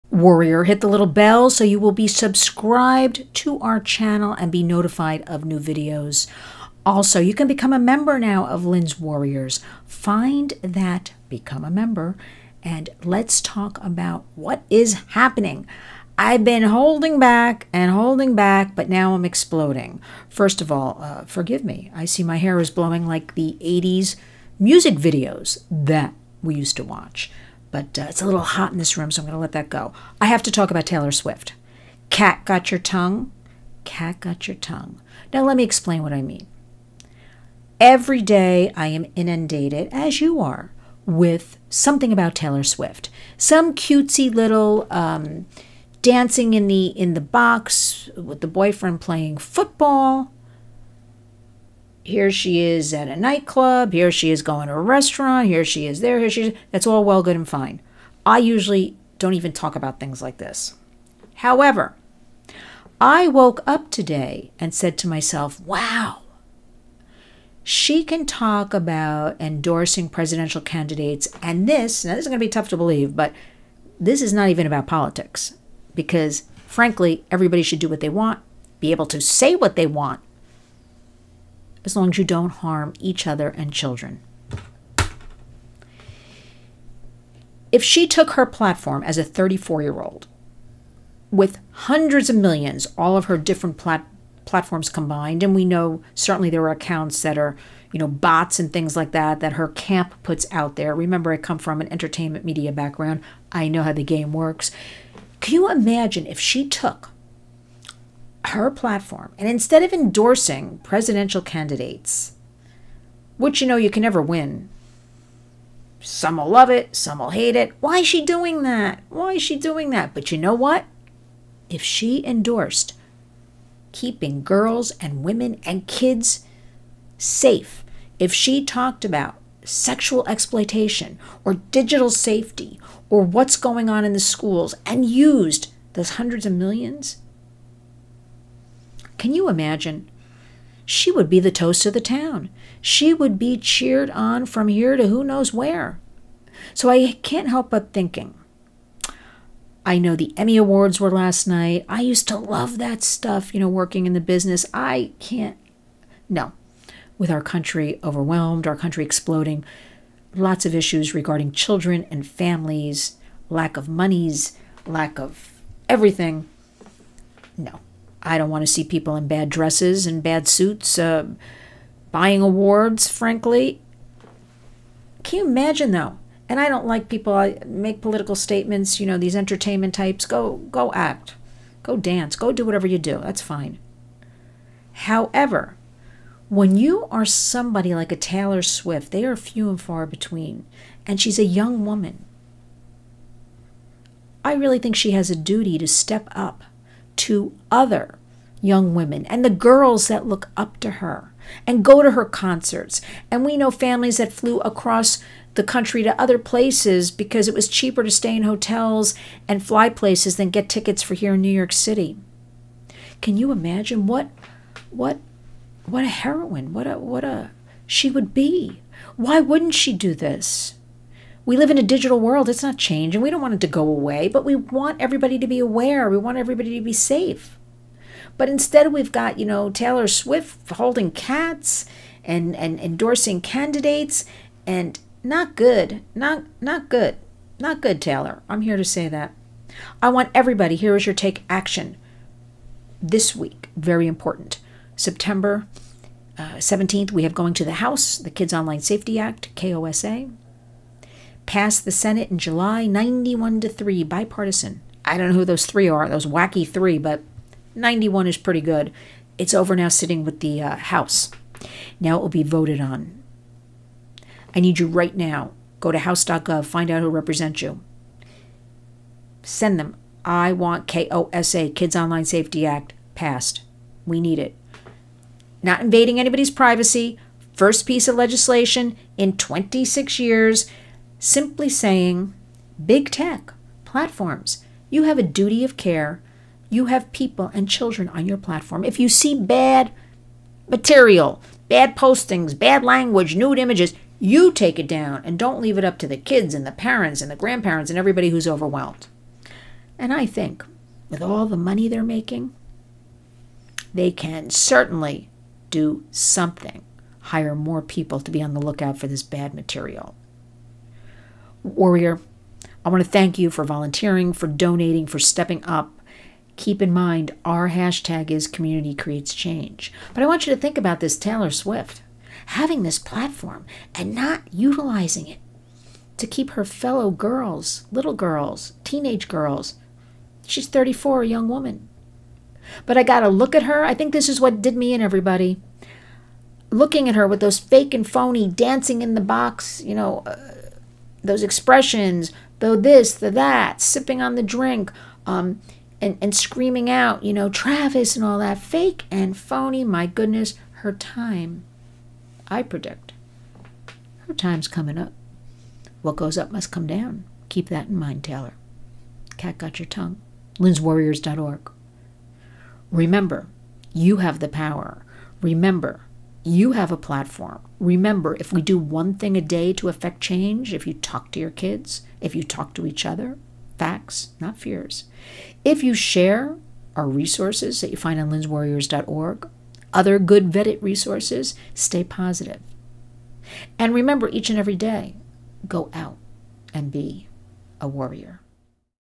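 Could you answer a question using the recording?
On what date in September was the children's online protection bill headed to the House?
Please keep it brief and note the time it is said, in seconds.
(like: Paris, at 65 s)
September 17, at 244 s.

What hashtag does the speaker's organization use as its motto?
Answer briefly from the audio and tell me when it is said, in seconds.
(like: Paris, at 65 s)
community creates change, at 318 s.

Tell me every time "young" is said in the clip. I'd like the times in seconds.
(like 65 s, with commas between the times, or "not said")
191 s, 198 s, 331 s.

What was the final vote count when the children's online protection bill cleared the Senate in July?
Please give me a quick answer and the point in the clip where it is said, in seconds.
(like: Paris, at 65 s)
91 to 3, at 252 s.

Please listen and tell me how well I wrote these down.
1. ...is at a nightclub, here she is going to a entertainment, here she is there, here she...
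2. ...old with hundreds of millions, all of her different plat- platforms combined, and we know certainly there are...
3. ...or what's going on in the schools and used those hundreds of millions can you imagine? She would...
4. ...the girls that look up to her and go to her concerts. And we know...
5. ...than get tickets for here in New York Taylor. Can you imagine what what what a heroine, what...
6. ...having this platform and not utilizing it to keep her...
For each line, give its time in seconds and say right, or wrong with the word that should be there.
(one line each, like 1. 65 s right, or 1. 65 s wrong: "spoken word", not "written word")
1. 52 s wrong: "restaurant", not "entertainment"
2. 90 s right
3. 133 s right
4. 199 s right
5. 210 s wrong: "City", not "Taylor"
6. 322 s right.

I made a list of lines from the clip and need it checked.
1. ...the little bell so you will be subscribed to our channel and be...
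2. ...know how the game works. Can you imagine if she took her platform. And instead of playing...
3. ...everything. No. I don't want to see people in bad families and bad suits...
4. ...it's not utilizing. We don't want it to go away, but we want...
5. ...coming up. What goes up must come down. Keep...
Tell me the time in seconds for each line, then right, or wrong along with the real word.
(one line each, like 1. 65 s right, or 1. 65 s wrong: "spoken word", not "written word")
1. 0 s right
2. 103 s wrong: "endorsing", not "playing"
3. 165 s wrong: "dresses", not "families"
4. 222 s wrong: "changing", not "utilizing"
5. 354 s right.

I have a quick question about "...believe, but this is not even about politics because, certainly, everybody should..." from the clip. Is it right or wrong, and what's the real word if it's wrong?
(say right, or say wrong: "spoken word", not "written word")
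wrong: "frankly", not "certainly".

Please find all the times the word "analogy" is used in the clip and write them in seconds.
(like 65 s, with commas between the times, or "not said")
not said.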